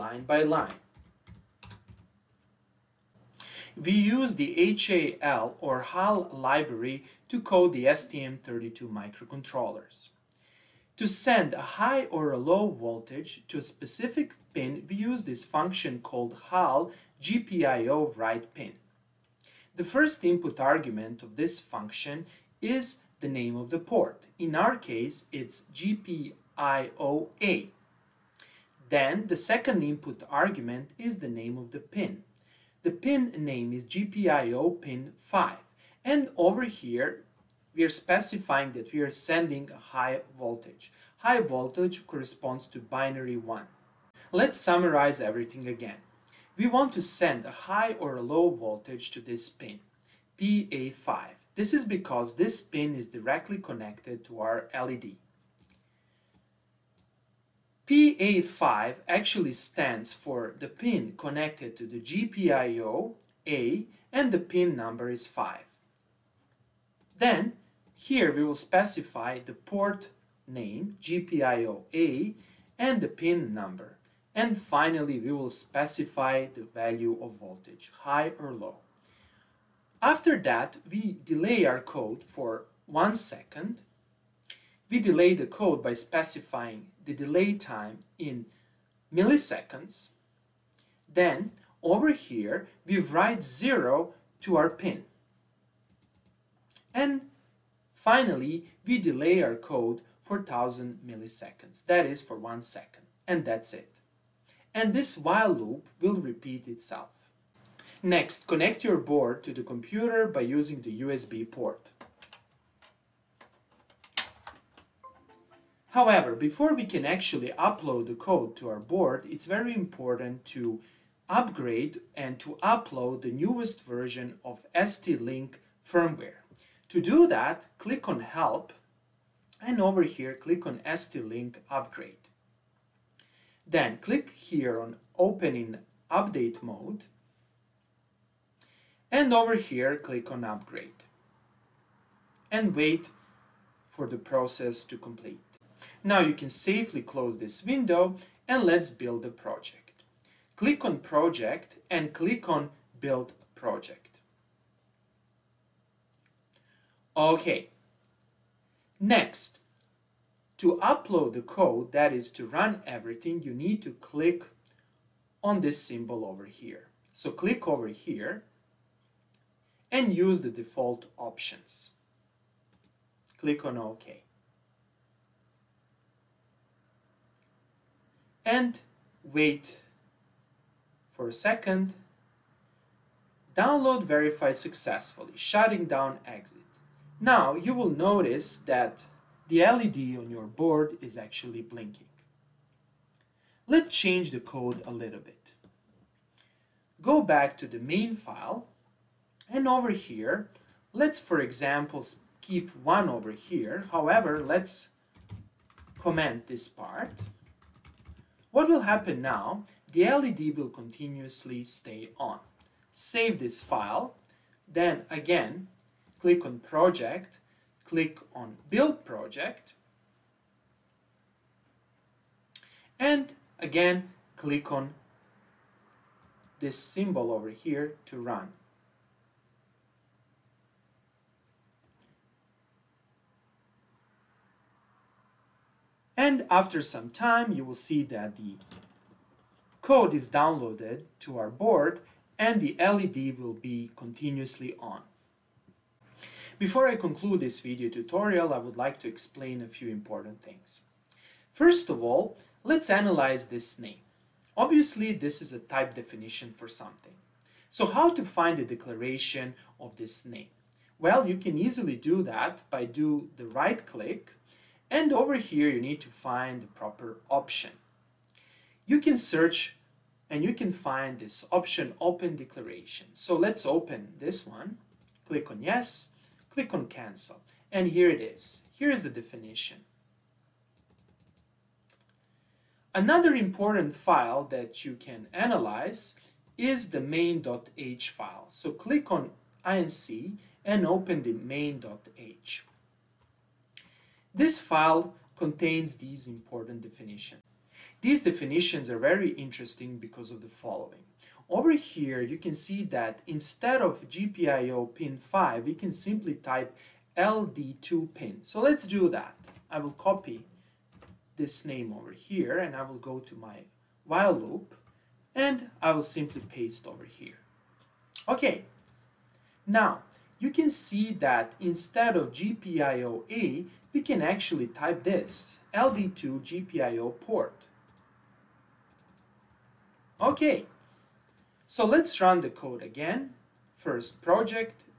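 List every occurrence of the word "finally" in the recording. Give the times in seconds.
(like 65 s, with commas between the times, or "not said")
74 s, 97 s.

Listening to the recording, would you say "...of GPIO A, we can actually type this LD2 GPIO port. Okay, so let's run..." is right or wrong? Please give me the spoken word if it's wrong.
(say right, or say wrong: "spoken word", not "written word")
right.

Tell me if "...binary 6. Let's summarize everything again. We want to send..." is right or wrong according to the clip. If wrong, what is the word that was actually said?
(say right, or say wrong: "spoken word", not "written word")
wrong: "1", not "6".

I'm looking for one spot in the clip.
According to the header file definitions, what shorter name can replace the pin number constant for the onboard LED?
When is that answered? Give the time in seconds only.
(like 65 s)
307 s.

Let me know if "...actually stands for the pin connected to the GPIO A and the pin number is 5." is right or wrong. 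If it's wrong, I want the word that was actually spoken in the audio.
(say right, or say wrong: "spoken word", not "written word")
right.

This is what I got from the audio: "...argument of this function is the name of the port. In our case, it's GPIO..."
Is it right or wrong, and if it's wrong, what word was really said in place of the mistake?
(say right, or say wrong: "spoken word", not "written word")
right.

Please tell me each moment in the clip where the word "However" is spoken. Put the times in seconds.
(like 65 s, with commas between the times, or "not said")
115 s, 203 s.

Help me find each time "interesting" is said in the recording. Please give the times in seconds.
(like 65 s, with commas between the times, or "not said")
299 s.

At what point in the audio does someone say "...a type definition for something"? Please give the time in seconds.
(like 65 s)
255 s.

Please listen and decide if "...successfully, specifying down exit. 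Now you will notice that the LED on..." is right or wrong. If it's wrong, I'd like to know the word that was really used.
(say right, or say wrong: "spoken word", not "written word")
wrong: "shutting", not "specifying".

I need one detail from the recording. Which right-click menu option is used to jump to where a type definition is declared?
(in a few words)
open declaration.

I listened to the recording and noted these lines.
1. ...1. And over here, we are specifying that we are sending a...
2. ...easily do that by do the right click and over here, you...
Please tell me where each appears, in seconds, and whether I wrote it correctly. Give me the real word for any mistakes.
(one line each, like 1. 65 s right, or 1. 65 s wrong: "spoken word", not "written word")
1. 35 s wrong: "5", not "1"
2. 261 s right.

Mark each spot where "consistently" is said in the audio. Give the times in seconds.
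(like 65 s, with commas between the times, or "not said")
not said.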